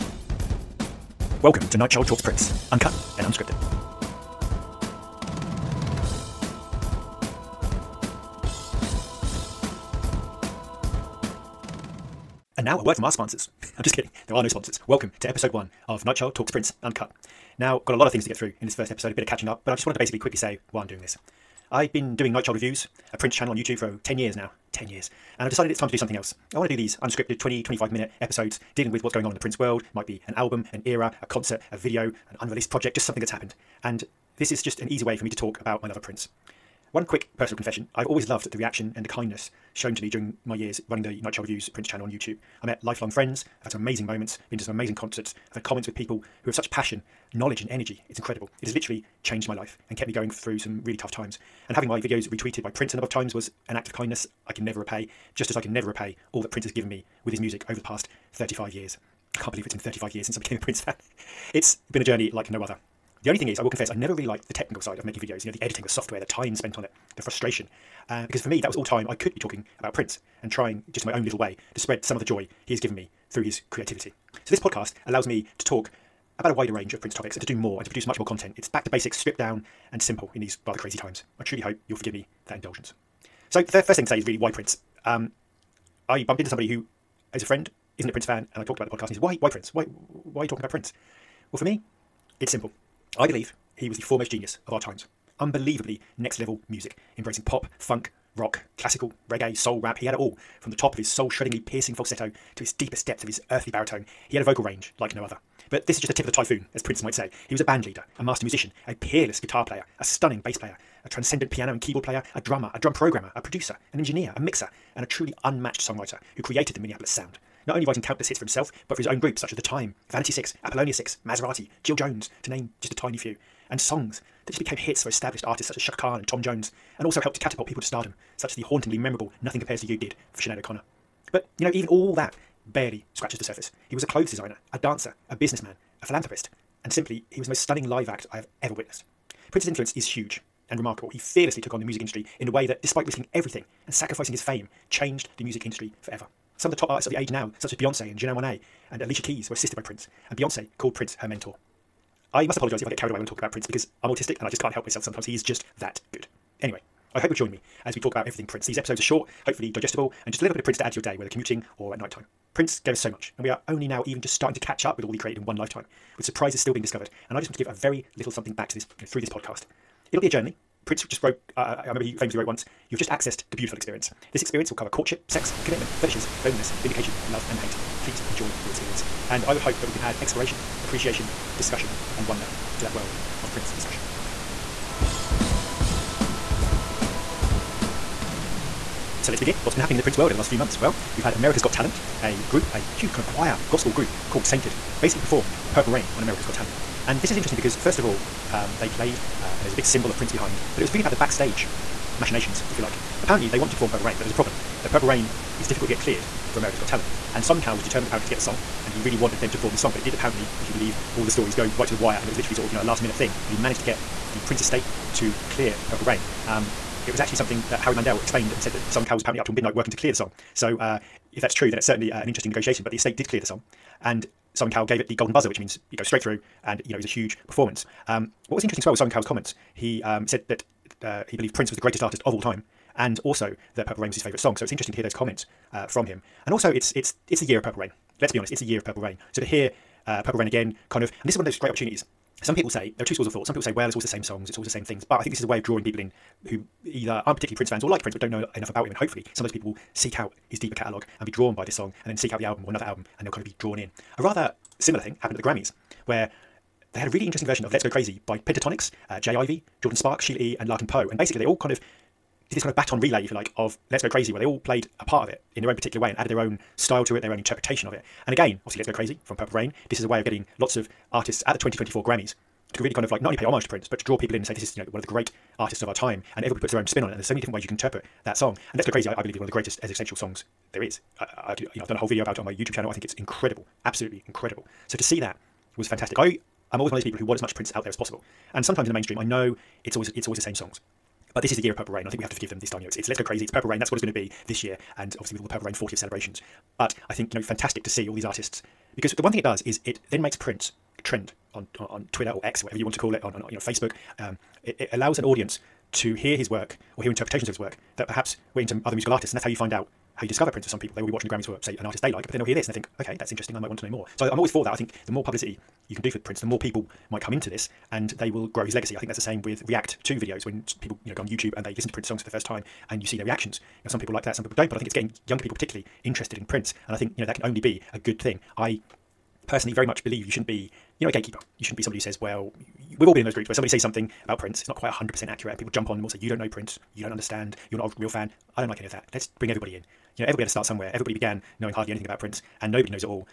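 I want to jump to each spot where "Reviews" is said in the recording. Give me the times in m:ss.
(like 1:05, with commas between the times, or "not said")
0:22, 0:41.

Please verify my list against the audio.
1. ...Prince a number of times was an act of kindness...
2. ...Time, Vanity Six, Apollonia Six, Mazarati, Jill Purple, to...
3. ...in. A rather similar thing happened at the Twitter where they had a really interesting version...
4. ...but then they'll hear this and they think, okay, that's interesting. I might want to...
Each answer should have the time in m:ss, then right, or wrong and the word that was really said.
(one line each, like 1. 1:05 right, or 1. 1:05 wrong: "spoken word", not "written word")
1. 0:52 right
2. 1:59 wrong: "Jones", not "Purple"
3. 4:13 wrong: "Grammys", not "Twitter"
4. 5:12 right.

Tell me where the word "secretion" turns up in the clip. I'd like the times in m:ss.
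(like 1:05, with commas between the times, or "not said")
not said.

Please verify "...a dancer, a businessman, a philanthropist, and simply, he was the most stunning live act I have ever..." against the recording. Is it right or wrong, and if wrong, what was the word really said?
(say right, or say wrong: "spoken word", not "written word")
right.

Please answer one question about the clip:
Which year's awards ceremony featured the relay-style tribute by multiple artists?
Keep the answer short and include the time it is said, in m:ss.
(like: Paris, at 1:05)
2024, at 4:31.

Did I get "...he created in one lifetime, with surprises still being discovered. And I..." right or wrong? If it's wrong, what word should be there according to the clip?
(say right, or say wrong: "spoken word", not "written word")
right.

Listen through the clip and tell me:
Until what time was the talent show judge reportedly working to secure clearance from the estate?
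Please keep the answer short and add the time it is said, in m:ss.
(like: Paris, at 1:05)
midnight, at 3:39.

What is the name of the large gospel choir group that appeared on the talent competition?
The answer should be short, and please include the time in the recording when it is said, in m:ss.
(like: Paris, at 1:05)
Sainted, at 3:14.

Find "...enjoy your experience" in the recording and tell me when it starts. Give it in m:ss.
2:58.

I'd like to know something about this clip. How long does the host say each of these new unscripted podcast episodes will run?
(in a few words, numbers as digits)
20 to 25 minutes.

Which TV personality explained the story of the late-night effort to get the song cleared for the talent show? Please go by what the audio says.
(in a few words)
Howie Mandel.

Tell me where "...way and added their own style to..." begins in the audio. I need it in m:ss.
4:25.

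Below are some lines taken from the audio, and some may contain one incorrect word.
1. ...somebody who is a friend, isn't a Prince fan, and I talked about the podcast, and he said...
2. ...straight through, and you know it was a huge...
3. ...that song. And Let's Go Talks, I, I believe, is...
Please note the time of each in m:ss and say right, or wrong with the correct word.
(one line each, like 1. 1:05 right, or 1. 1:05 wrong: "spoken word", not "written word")
1. 1:26 right
2. 3:46 right
3. 4:38 wrong: "Crazy", not "Talks".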